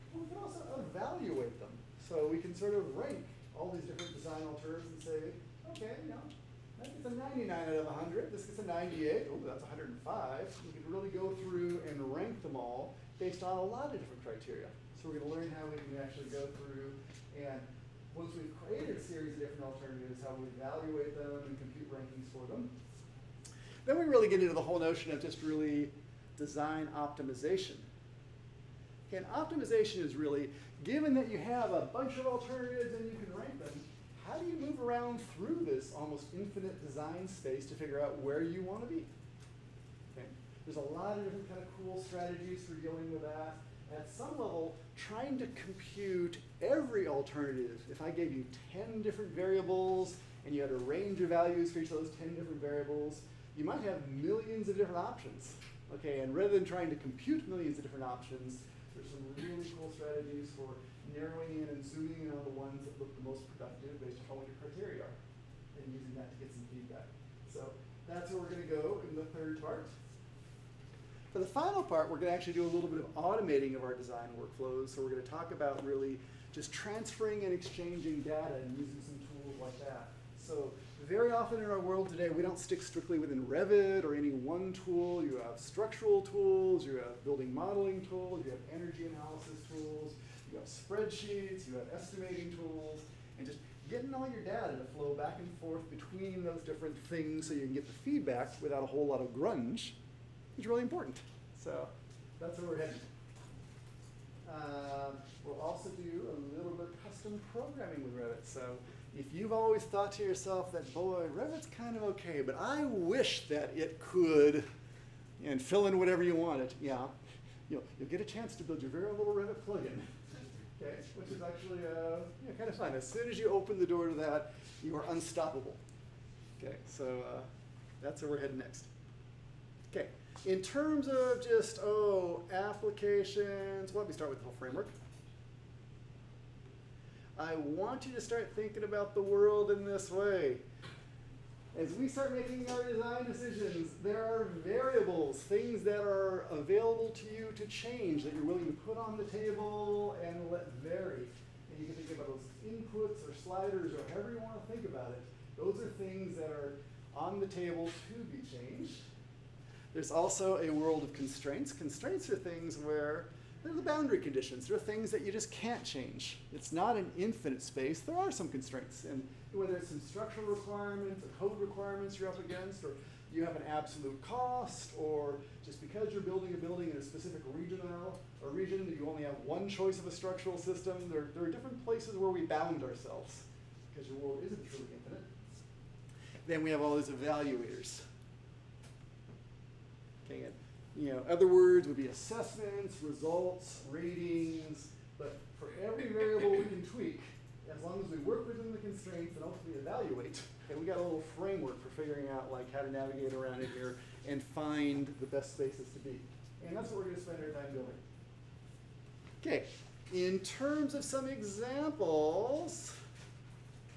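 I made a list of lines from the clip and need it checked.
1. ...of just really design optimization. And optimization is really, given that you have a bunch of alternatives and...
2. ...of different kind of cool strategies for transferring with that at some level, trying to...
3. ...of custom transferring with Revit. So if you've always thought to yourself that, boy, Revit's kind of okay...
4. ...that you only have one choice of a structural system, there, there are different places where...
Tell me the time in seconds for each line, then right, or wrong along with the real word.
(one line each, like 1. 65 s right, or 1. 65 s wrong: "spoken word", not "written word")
1. 25 s right
2. 41 s wrong: "dealing", not "transferring"
3. 106 s wrong: "programming", not "transferring"
4. 178 s right.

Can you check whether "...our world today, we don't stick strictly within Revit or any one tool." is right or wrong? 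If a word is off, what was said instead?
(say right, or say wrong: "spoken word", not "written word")
right.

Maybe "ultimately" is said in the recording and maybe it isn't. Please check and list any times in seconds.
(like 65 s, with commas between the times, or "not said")
199 s.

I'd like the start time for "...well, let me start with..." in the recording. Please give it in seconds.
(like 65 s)
133 s.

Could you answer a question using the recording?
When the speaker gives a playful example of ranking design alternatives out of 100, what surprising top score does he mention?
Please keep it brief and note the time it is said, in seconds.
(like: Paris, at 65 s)
105, at 9 s.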